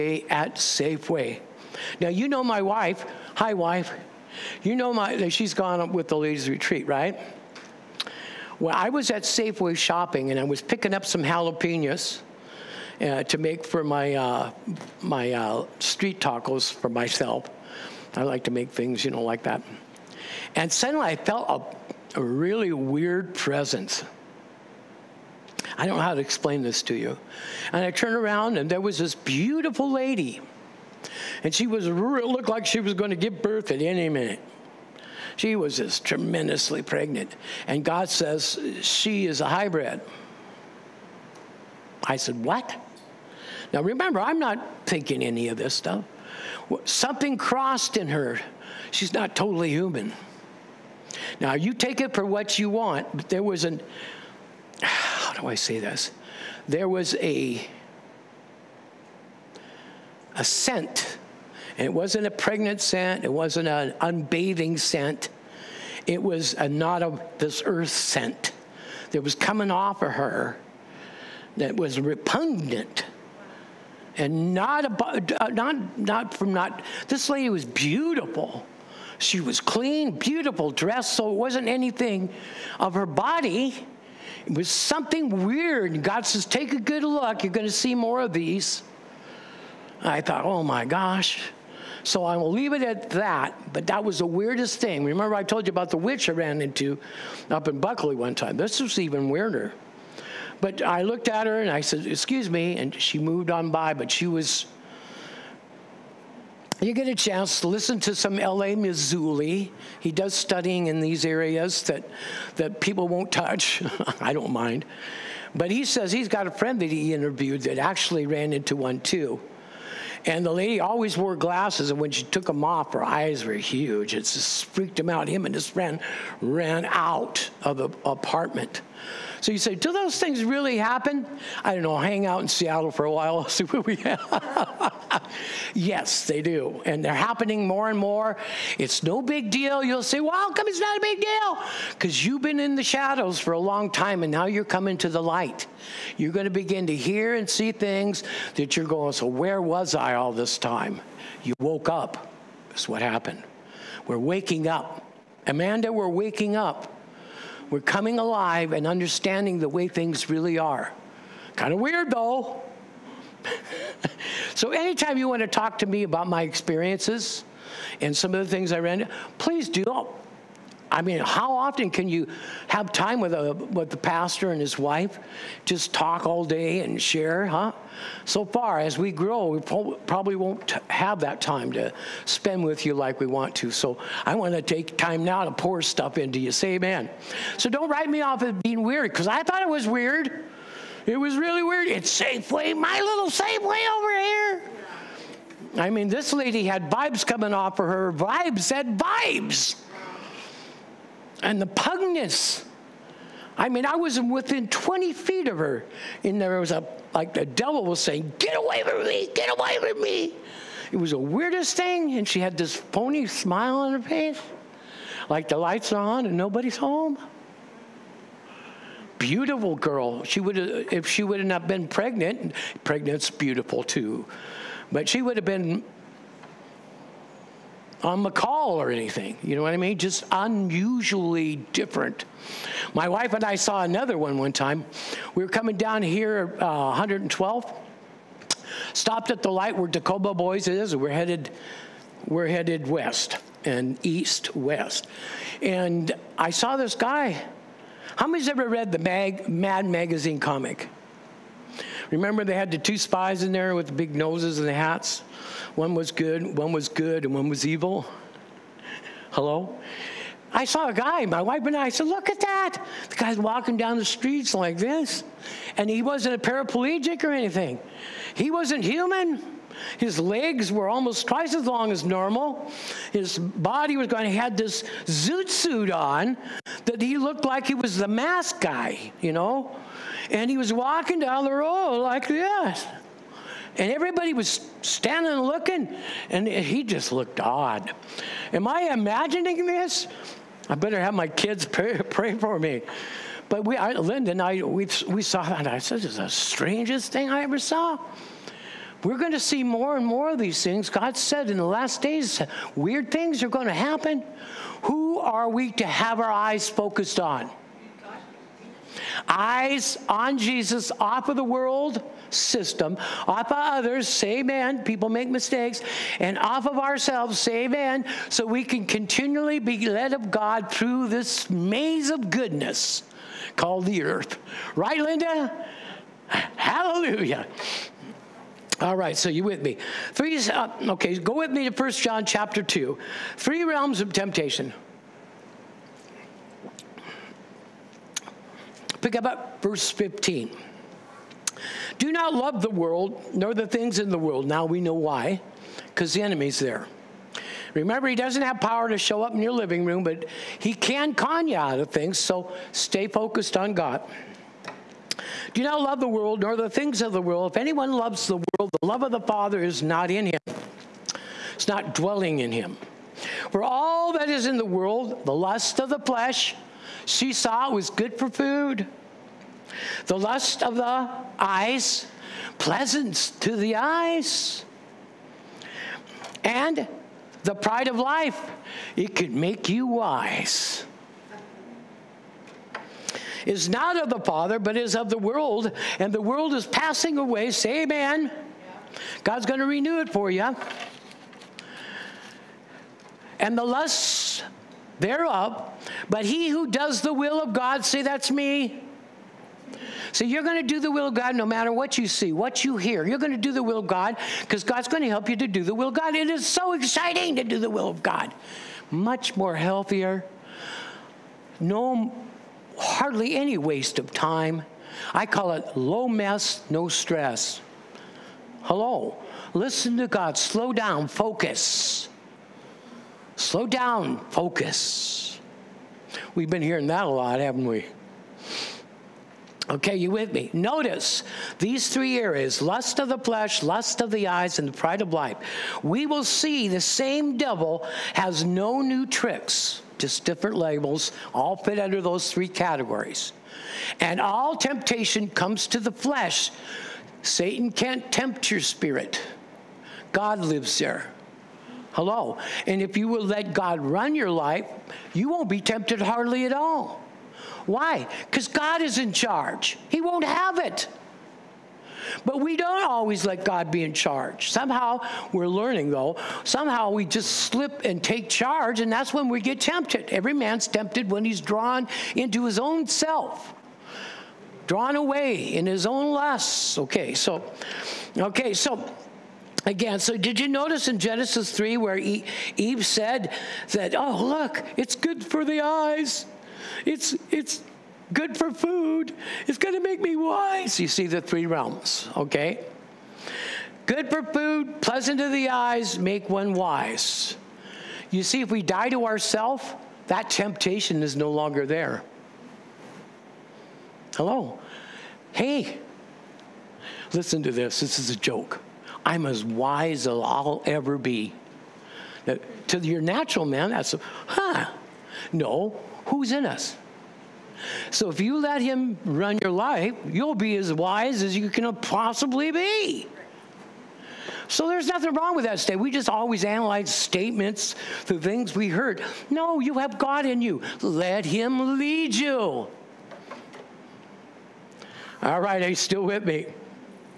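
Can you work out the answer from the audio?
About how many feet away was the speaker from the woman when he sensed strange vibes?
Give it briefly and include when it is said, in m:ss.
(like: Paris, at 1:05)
20, at 3:24.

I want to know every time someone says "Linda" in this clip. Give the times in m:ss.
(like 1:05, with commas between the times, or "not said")
4:53, 5:24.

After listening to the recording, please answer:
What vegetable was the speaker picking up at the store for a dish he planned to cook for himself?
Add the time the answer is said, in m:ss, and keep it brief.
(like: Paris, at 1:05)
Jalapenos, at 0:11.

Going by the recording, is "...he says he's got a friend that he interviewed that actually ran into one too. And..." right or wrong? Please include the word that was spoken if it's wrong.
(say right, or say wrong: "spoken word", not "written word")
right.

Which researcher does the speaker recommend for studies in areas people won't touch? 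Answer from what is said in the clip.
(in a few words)
L.A. Marzulli.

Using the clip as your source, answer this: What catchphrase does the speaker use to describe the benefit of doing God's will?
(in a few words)
Low mess, no stress.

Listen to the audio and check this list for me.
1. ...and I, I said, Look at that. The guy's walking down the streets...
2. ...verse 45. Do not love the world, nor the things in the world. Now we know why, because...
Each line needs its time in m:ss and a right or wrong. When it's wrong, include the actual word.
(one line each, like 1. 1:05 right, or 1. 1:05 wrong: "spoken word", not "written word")
1. 4:21 right
2. 5:39 wrong: "15", not "45".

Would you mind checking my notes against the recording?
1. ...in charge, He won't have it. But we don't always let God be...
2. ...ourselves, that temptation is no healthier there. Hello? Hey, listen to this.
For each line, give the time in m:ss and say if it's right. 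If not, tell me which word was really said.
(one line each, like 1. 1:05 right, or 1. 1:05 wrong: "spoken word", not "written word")
1. 7:38 right
2. 8:19 wrong: "longer", not "healthier".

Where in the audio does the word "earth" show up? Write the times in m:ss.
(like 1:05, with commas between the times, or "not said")
1:07, 5:24.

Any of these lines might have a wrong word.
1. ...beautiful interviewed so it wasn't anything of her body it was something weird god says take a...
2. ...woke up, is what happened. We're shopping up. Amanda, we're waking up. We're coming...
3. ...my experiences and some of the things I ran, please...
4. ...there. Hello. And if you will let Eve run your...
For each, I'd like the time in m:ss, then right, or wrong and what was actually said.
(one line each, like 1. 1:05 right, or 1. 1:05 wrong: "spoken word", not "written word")
1. 1:20 wrong: "dressed", not "interviewed"
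2. 2:31 wrong: "waking", not "shopping"
3. 2:46 right
4. 7:30 wrong: "God", not "Eve".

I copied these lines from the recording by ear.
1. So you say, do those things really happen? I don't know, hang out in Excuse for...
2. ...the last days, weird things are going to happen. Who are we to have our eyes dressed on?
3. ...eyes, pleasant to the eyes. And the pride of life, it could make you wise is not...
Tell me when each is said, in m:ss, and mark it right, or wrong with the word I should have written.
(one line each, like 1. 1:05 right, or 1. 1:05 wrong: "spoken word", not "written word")
1. 2:09 wrong: "Seattle", not "Excuse"
2. 5:01 wrong: "focused", not "dressed"
3. 6:11 right.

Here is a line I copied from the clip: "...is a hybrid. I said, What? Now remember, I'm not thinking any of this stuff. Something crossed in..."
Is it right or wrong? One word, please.
right.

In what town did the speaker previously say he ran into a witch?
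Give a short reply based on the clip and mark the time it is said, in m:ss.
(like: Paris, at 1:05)
Buckley, at 1:37.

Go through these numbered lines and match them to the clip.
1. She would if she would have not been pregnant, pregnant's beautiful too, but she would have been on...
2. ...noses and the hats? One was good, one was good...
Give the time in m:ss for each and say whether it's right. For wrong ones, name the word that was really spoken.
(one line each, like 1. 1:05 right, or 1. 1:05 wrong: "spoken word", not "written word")
1. 3:40 right
2. 4:14 right.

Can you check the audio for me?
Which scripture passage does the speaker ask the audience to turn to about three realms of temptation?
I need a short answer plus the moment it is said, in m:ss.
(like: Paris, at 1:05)
First John chapter 2, at 5:31.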